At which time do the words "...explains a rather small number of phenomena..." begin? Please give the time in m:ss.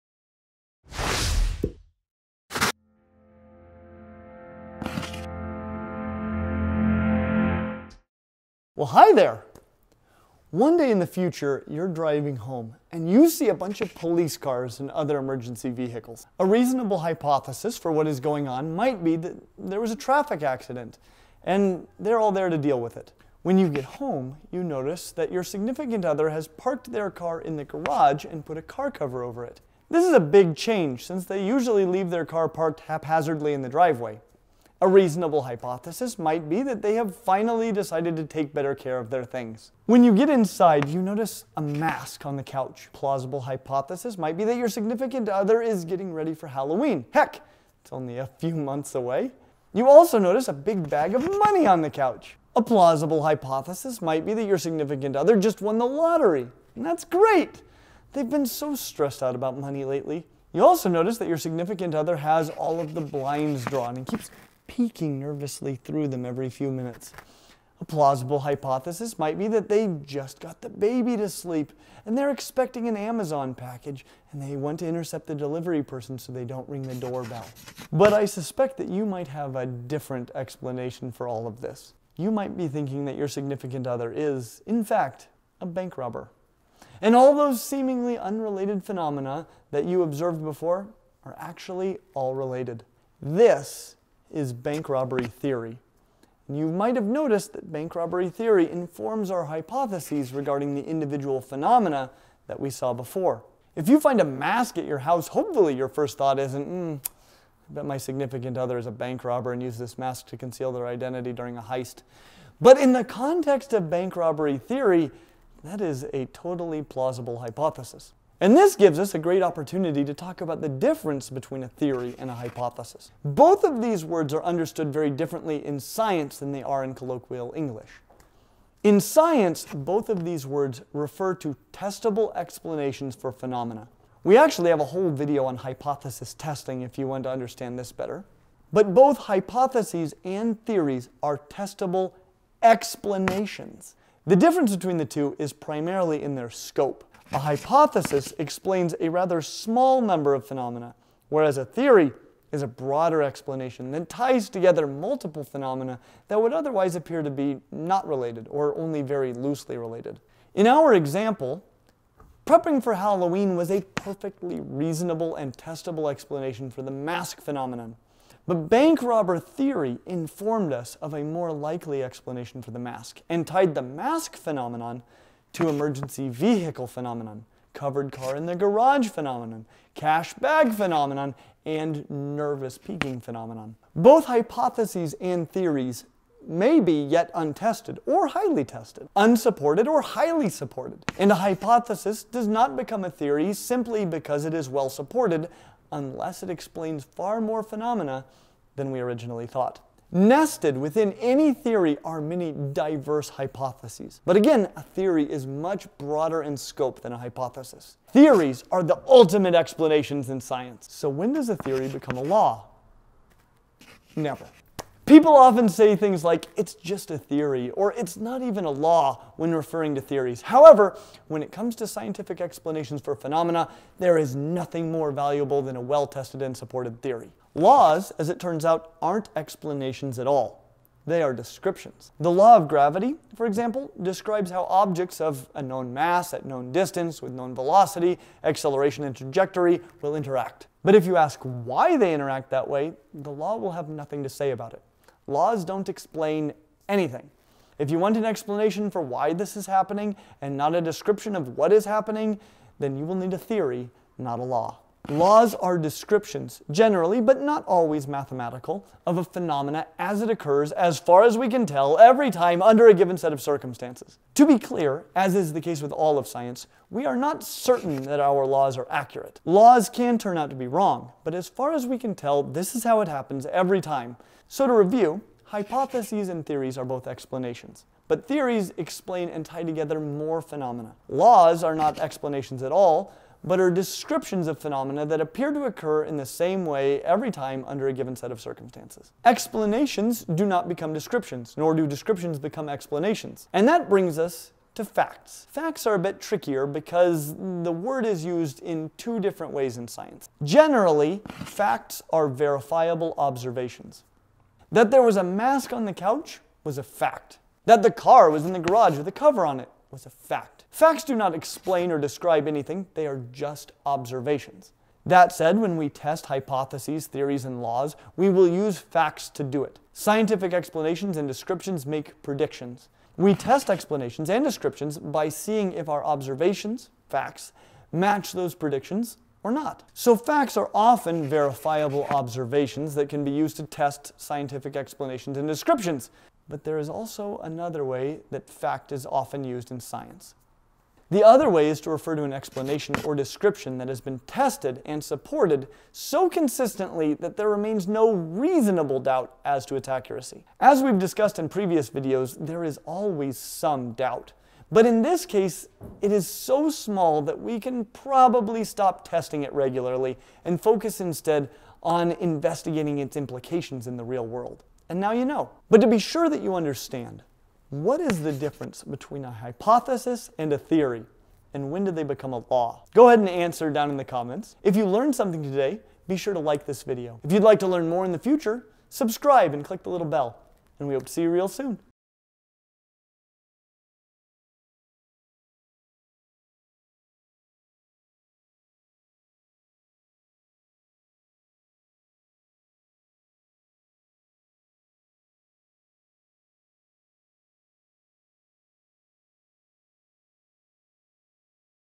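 2:28.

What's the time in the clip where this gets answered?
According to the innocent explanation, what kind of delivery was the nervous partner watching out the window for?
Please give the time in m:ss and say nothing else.
1:12.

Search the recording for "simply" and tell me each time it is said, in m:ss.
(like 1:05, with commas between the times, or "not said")
3:13.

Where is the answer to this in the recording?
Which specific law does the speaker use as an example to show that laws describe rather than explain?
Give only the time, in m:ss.
3:52.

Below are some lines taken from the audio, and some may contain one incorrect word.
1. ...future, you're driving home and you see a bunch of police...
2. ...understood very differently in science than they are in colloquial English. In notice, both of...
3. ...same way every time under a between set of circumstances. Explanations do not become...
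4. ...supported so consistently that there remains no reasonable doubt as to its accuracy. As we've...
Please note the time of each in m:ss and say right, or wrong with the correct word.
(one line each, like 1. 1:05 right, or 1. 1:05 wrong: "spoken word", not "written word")
1. 0:11 right
2. 2:04 wrong: "science", not "notice"
3. 4:46 wrong: "given", not "between"
4. 5:45 right.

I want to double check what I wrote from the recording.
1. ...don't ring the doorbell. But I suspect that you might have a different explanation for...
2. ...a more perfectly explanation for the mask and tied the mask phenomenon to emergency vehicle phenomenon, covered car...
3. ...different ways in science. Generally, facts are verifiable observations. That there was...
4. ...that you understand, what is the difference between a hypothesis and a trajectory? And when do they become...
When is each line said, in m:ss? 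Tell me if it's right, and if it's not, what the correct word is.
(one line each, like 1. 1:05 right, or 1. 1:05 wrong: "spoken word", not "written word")
1. 1:16 right
2. 2:51 wrong: "likely", not "perfectly"
3. 4:59 right
4. 6:06 wrong: "theory", not "trajectory".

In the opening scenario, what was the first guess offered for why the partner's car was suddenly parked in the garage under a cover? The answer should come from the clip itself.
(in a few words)
Take better care of their things.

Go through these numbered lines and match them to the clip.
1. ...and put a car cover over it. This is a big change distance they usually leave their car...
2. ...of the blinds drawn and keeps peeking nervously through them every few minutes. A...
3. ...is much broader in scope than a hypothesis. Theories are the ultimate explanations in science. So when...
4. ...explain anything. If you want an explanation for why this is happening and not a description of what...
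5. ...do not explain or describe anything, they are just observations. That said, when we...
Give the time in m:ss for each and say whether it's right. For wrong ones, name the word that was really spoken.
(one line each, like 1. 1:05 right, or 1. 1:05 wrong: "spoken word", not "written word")
1. 0:28 wrong: "since", not "distance"
2. 1:02 right
3. 3:25 right
4. 4:05 right
5. 5:11 right.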